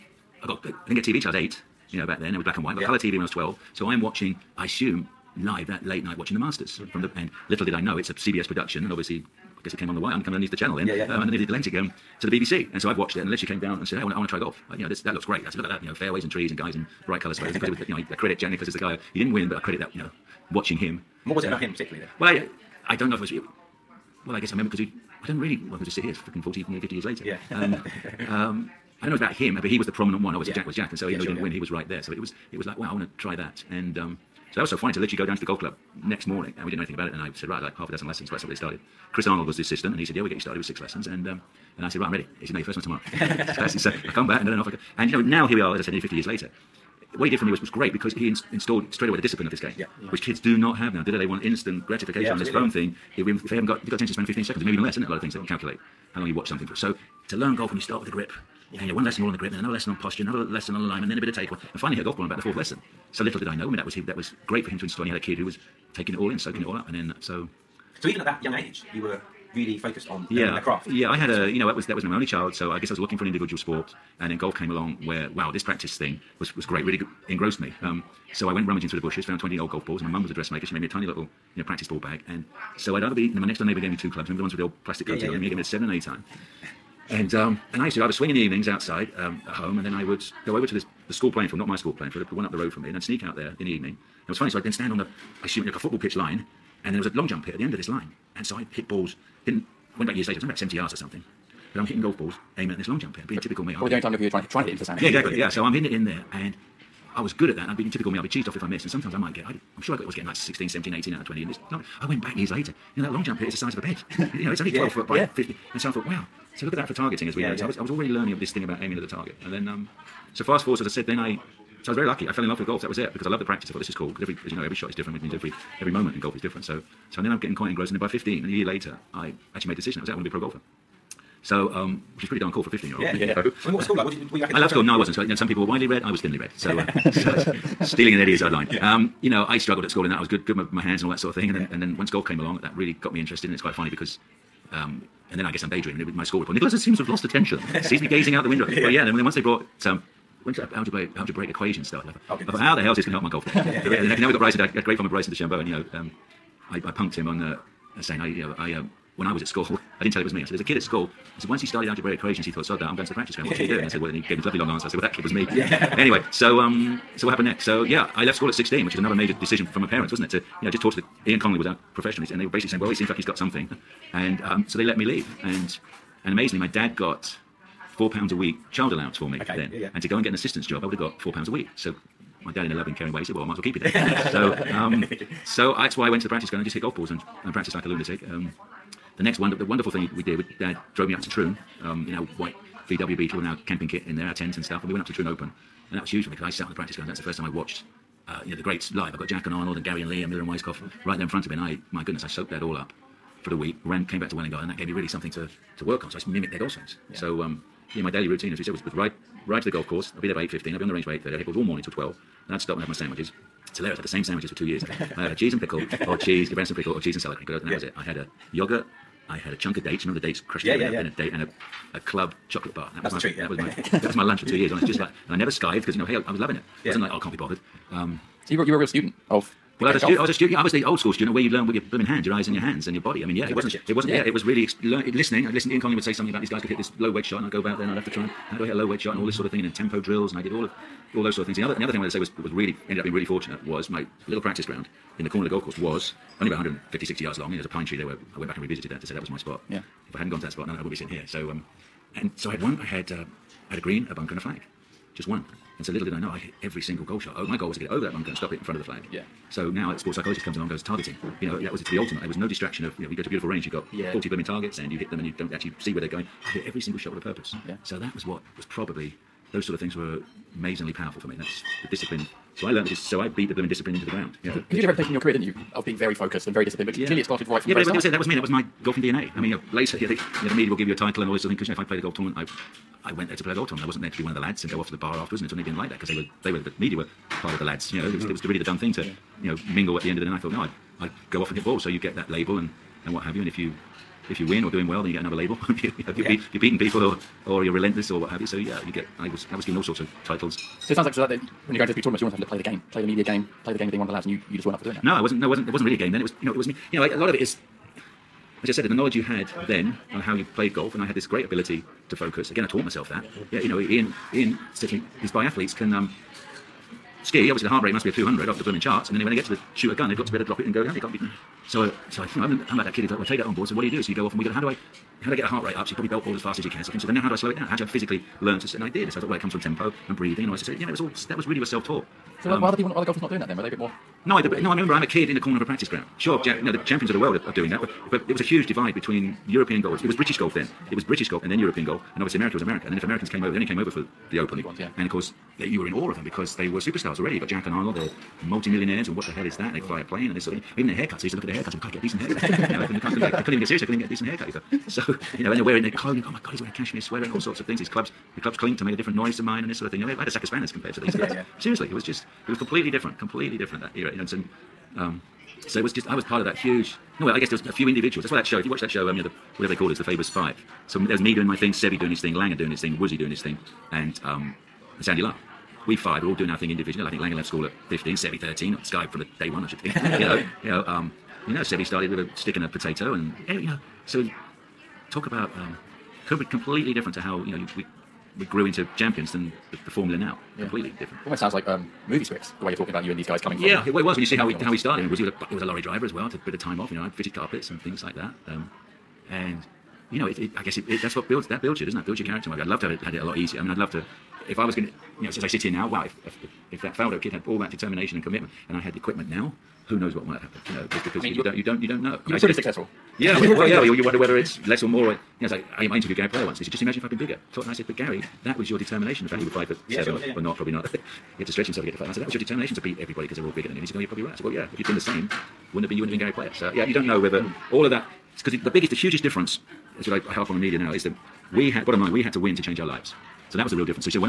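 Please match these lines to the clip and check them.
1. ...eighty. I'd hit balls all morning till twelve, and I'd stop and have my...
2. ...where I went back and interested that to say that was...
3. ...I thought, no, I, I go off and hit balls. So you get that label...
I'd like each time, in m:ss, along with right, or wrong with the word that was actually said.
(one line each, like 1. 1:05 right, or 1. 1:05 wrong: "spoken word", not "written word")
1. 3:31 wrong: "thirty", not "eighty"
2. 4:08 wrong: "revisited", not "interested"
3. 4:50 right.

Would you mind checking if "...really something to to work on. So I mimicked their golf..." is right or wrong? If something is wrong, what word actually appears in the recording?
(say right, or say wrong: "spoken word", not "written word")
right.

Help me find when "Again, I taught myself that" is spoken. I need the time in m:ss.
5:12.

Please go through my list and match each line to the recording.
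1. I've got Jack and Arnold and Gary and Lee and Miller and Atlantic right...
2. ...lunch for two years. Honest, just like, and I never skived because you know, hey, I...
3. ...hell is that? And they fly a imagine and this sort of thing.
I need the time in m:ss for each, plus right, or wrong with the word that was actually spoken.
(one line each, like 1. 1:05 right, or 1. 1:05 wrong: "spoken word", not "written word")
1. 3:19 wrong: "Weiskopf", not "Atlantic"
2. 3:44 right
3. 5:49 wrong: "plane", not "imagine".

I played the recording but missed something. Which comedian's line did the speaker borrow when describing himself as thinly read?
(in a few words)
Eddie Izzard.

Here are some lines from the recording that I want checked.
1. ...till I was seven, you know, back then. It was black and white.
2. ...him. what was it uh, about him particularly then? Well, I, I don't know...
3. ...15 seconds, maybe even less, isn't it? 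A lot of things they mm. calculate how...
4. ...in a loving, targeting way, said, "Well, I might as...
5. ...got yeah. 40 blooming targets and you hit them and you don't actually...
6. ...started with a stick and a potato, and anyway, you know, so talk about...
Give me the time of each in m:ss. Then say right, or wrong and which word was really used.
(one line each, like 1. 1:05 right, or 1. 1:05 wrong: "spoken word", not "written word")
1. 0:01 wrong: "eight", not "seven"
2. 0:20 right
3. 0:54 right
4. 3:02 wrong: "caring", not "targeting"
5. 4:23 right
6. 6:21 right.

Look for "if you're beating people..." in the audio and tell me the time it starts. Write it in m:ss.
4:56.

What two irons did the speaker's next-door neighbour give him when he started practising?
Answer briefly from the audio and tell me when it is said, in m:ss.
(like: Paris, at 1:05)
Seven and eight iron, at 1:25.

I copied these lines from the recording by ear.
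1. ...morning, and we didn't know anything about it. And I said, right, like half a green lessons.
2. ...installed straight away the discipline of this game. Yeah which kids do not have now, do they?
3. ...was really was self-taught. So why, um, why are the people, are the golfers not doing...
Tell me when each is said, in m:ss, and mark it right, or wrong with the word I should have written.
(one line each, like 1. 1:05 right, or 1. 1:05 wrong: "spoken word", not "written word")
1. 0:36 wrong: "dozen", not "green"
2. 0:48 right
3. 5:31 right.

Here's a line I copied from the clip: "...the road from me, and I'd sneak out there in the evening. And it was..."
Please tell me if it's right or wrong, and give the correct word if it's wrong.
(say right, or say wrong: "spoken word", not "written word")
right.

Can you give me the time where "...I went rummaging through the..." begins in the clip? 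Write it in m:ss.
1:18.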